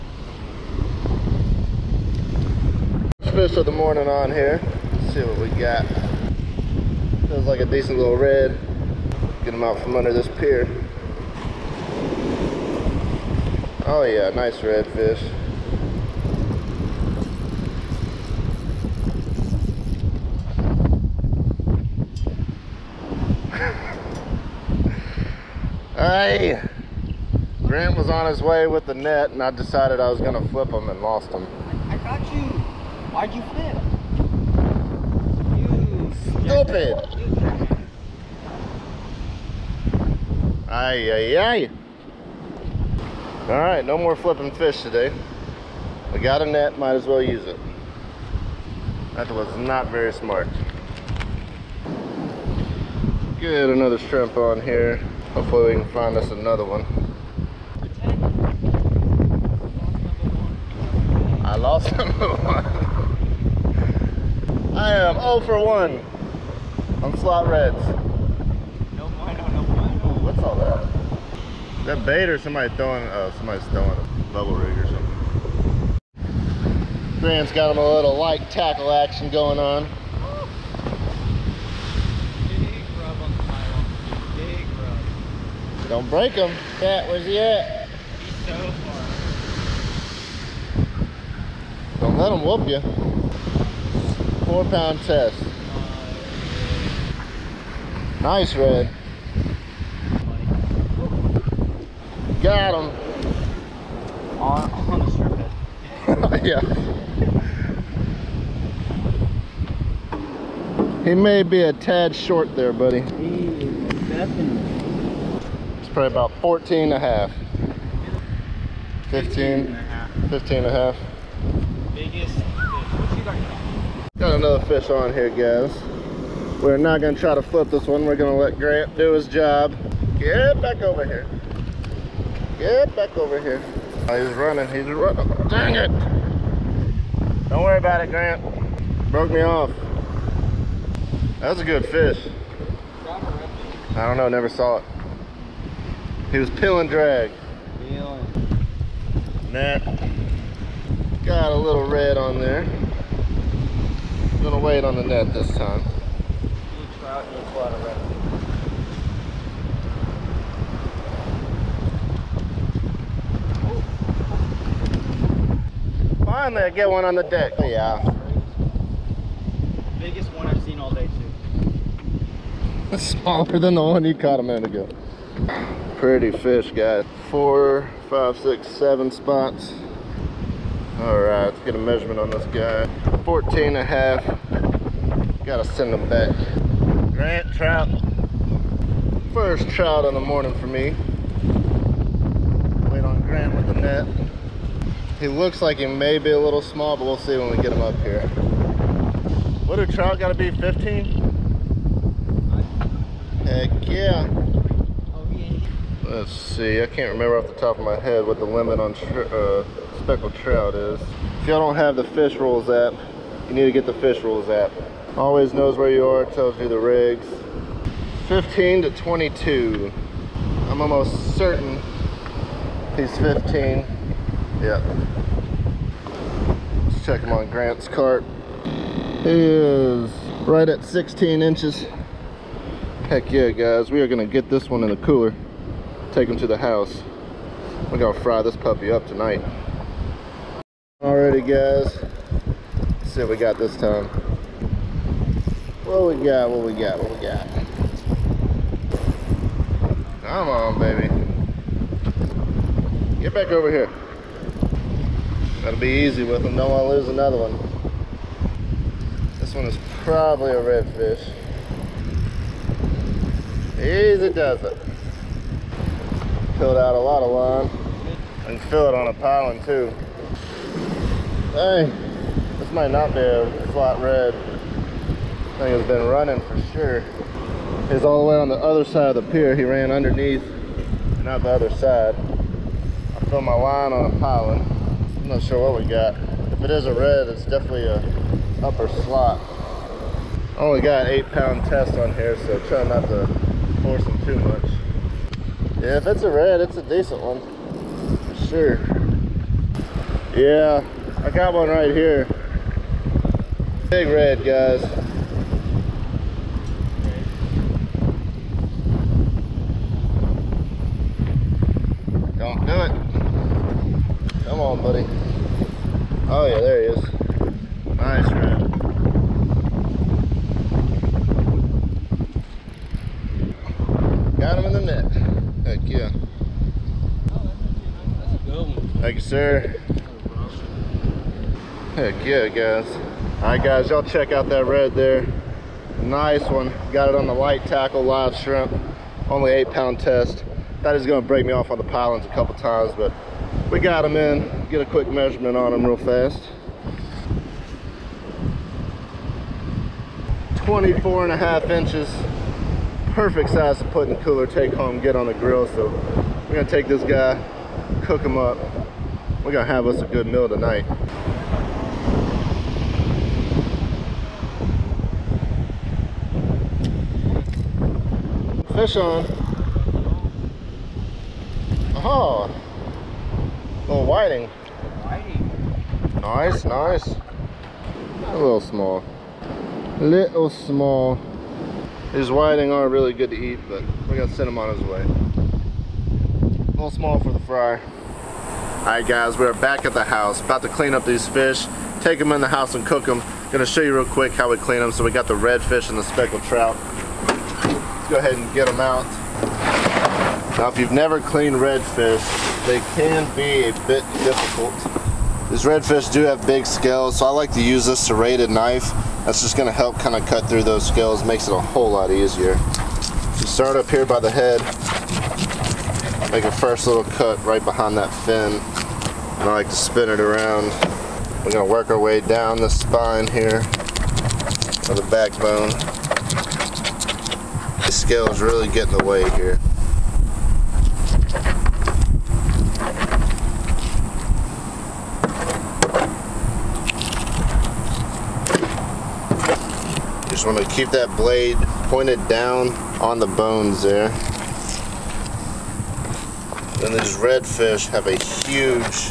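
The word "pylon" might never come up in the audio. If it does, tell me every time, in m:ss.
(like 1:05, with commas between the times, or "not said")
4:44, 5:41.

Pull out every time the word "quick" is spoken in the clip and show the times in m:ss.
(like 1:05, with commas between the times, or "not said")
5:44, 6:34.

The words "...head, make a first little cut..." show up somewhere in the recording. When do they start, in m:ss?
6:54.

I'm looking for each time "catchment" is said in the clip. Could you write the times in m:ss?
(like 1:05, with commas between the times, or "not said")
not said.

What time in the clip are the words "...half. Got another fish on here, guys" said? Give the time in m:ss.
2:00.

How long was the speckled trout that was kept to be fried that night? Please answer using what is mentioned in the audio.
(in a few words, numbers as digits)
16 inches.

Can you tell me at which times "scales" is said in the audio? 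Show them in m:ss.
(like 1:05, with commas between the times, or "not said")
6:46, 6:50, 7:07.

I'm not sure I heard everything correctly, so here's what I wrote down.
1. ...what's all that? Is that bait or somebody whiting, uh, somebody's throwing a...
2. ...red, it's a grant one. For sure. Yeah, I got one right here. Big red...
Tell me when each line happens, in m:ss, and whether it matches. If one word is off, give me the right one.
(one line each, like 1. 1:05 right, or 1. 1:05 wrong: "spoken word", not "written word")
1. 1:10 wrong: "throwing", not "whiting"
2. 4:56 wrong: "decent", not "grant".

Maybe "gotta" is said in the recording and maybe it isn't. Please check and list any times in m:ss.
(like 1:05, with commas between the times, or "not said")
3:05, 3:20, 6:24.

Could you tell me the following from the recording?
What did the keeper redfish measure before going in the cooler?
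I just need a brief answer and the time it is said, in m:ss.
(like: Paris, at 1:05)
24 and a half inches, at 5:50.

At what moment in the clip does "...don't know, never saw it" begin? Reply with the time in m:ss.
2:24.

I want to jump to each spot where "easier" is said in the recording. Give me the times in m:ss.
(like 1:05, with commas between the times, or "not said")
6:52.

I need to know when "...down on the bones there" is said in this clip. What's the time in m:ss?
7:22.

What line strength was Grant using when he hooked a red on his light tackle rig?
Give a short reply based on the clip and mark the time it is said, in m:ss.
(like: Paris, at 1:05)
4 pound test, at 1:34.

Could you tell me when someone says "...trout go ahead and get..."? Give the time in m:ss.
6:36.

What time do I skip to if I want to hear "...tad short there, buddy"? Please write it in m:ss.
1:51.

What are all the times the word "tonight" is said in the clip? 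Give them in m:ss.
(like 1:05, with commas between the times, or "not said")
3:59, 6:00.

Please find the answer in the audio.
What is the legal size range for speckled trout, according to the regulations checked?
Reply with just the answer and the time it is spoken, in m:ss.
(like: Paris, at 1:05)
15 to 22, at 3:38.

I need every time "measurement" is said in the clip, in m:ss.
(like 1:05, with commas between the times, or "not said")
3:01, 5:45.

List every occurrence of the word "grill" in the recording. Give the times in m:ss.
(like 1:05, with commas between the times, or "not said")
5:55.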